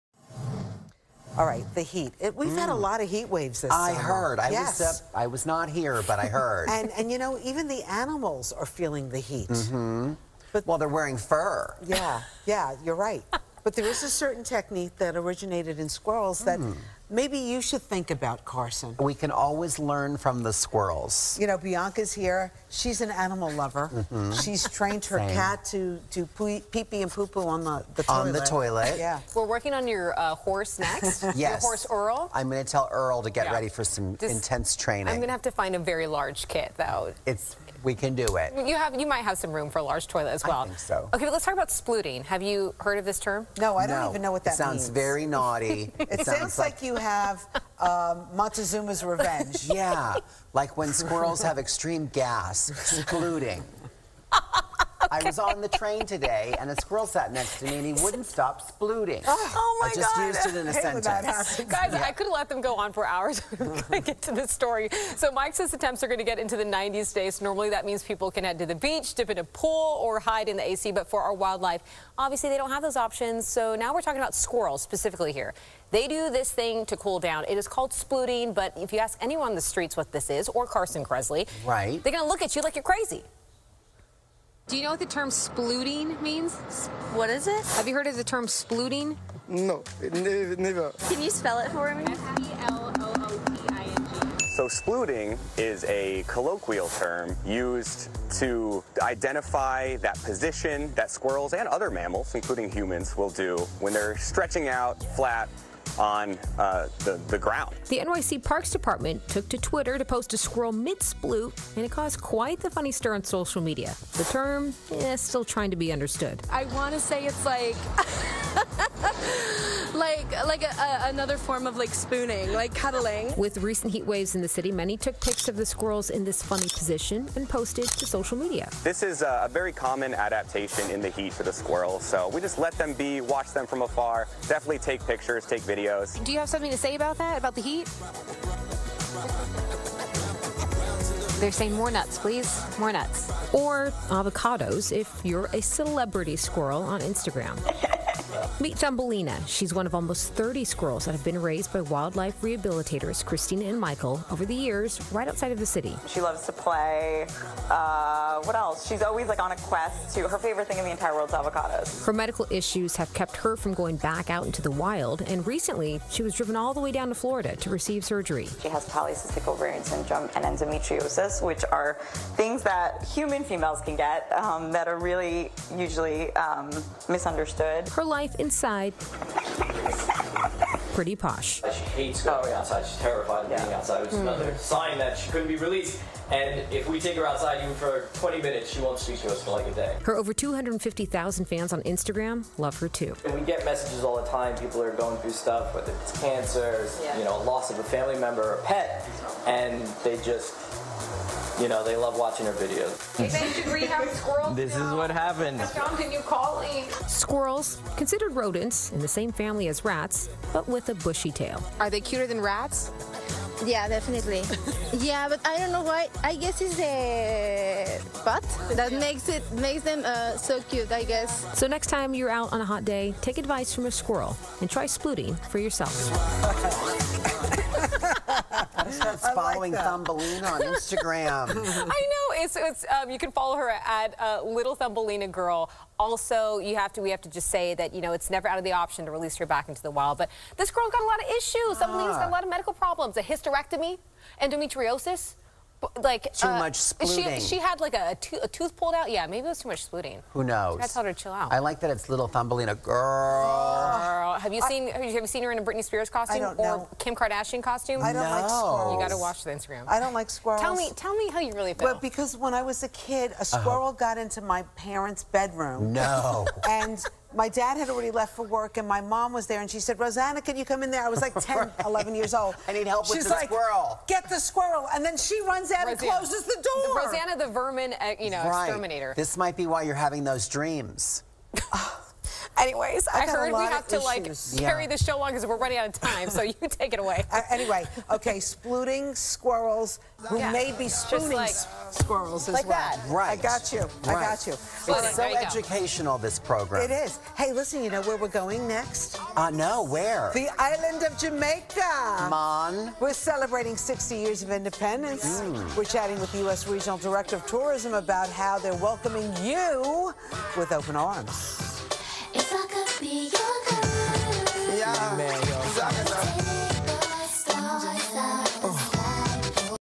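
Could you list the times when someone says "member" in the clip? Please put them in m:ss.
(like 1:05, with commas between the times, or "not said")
3:18.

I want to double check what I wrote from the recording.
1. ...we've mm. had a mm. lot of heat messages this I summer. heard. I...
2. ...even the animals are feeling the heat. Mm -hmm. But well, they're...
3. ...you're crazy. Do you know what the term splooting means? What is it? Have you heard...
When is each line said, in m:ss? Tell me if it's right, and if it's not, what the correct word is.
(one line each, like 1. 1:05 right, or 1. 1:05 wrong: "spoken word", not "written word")
1. 0:02 wrong: "waves", not "messages"
2. 0:07 right
3. 1:22 right.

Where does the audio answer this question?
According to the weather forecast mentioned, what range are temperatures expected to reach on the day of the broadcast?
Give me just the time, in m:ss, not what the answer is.
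1:06.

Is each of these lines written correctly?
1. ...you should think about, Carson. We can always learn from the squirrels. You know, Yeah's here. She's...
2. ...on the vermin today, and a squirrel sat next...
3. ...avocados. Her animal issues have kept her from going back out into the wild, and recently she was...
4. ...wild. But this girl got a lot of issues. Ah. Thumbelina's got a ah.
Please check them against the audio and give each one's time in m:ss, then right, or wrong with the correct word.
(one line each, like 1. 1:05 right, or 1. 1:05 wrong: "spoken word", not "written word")
1. 0:17 wrong: "Bianca", not "Yeah"
2. 0:55 wrong: "train", not "vermin"
3. 2:41 wrong: "medical", not "animal"
4. 3:59 right.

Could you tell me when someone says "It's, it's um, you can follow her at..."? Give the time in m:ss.
3:52.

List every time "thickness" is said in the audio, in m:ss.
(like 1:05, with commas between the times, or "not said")
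not said.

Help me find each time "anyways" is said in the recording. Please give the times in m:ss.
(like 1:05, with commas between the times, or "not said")
4:42, 4:47.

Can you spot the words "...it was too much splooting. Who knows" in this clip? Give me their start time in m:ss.
4:09.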